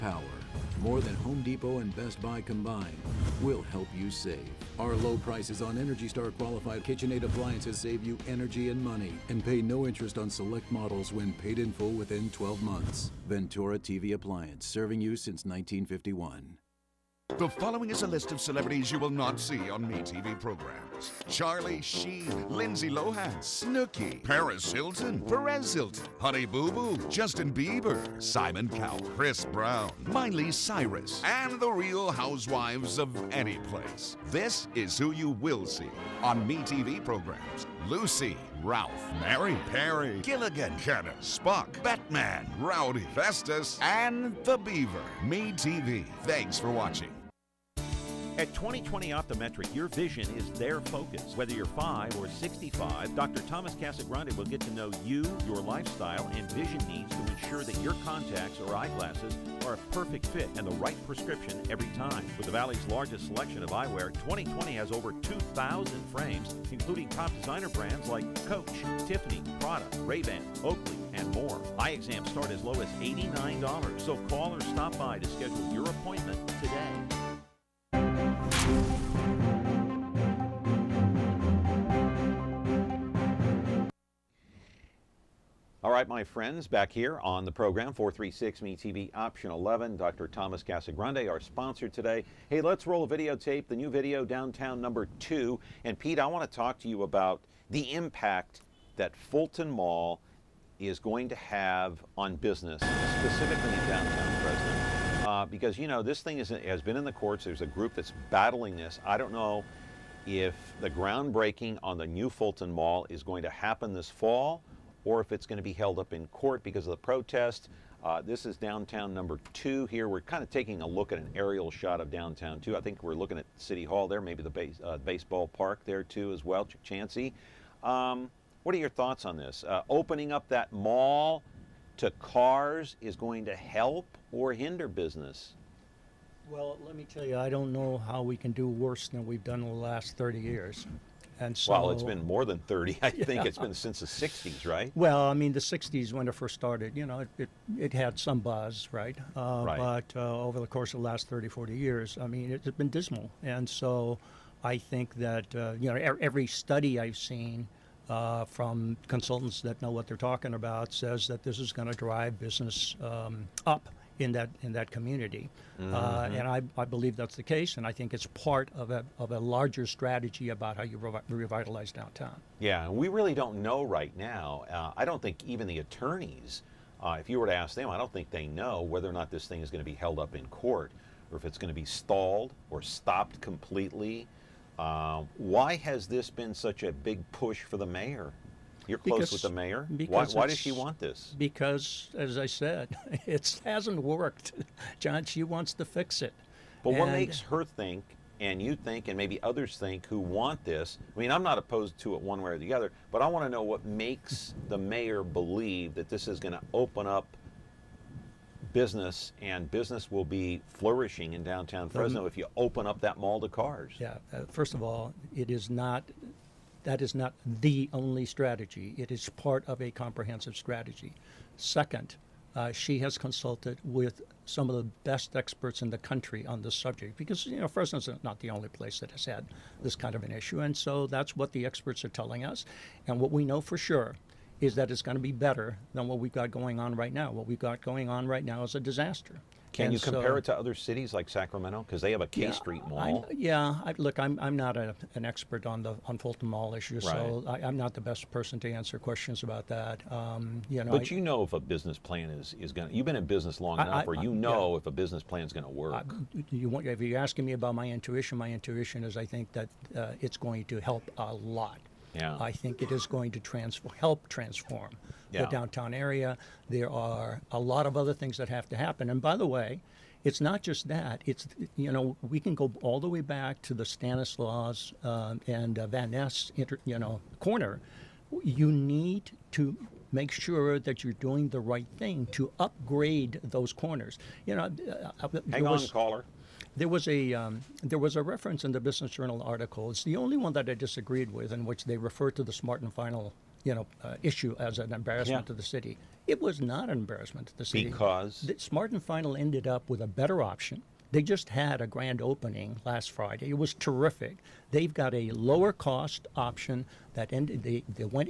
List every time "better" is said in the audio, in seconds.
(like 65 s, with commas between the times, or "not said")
235 s, 300 s.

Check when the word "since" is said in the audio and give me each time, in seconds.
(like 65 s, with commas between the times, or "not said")
15 s, 143 s.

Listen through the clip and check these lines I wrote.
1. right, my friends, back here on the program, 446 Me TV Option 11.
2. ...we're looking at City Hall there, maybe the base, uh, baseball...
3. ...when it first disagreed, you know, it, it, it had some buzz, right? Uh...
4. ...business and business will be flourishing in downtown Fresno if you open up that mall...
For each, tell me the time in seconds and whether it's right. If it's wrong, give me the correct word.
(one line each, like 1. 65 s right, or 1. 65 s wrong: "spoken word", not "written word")
1. 85 s wrong: "436", not "446"
2. 123 s right
3. 146 s wrong: "started", not "disagreed"
4. 208 s right.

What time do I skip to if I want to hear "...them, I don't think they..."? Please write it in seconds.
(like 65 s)
177 s.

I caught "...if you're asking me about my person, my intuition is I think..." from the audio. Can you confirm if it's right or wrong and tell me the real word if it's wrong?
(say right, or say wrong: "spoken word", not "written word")
wrong: "intuition", not "person".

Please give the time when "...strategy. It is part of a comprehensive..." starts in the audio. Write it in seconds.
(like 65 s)
218 s.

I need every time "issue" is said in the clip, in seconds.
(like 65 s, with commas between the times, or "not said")
230 s, 246 s, 294 s.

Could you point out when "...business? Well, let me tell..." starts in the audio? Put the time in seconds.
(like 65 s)
134 s.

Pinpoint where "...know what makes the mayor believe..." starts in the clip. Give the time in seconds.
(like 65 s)
203 s.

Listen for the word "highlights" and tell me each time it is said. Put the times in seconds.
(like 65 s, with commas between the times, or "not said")
not said.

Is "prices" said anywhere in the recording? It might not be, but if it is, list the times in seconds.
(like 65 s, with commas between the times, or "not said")
5 s.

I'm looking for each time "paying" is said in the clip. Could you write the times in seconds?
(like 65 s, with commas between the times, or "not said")
not said.